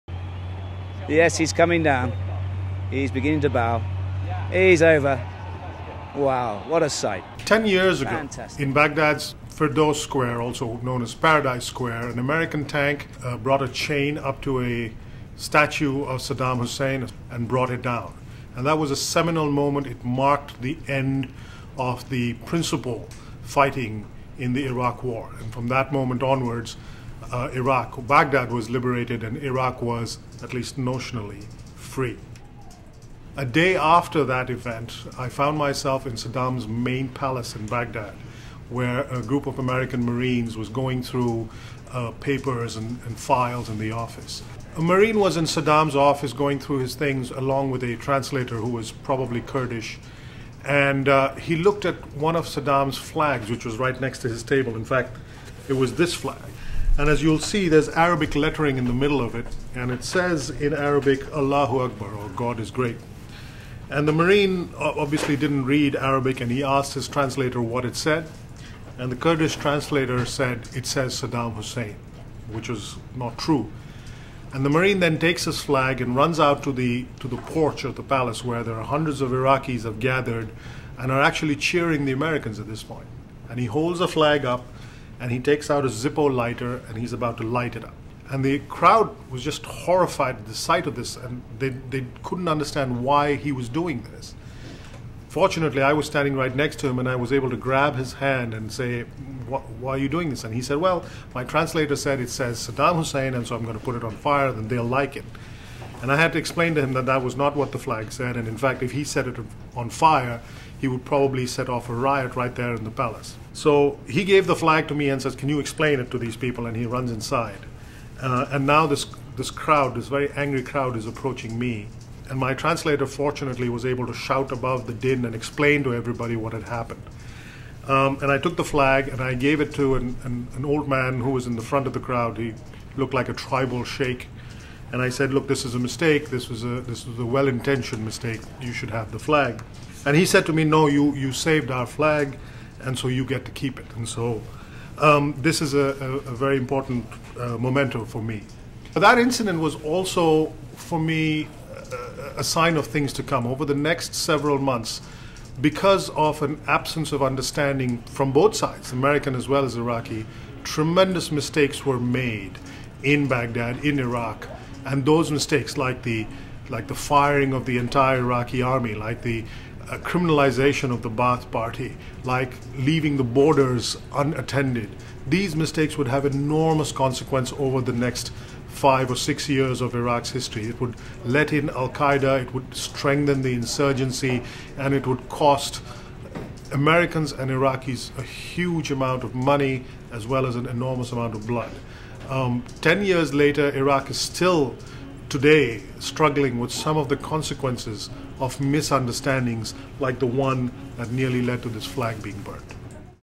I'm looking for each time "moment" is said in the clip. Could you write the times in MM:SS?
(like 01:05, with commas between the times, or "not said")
00:19, 00:25.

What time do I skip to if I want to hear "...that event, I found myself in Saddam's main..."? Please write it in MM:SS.
00:34.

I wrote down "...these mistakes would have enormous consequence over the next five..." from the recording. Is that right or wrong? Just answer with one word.
right.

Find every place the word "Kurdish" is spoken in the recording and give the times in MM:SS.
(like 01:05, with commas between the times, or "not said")
00:49, 01:09.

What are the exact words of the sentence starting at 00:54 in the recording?
In fact, it was this flag.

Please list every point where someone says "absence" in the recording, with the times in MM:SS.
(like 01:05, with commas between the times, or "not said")
02:36.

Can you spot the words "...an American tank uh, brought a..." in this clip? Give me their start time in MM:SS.
00:12.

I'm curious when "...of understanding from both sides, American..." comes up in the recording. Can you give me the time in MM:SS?
02:37.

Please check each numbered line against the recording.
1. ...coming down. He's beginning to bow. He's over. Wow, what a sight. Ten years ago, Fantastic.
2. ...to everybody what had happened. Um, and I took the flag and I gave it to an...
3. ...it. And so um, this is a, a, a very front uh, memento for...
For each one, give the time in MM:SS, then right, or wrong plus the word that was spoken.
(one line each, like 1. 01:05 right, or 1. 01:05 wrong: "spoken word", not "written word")
1. 00:01 right
2. 02:05 right
3. 02:23 wrong: "important", not "front".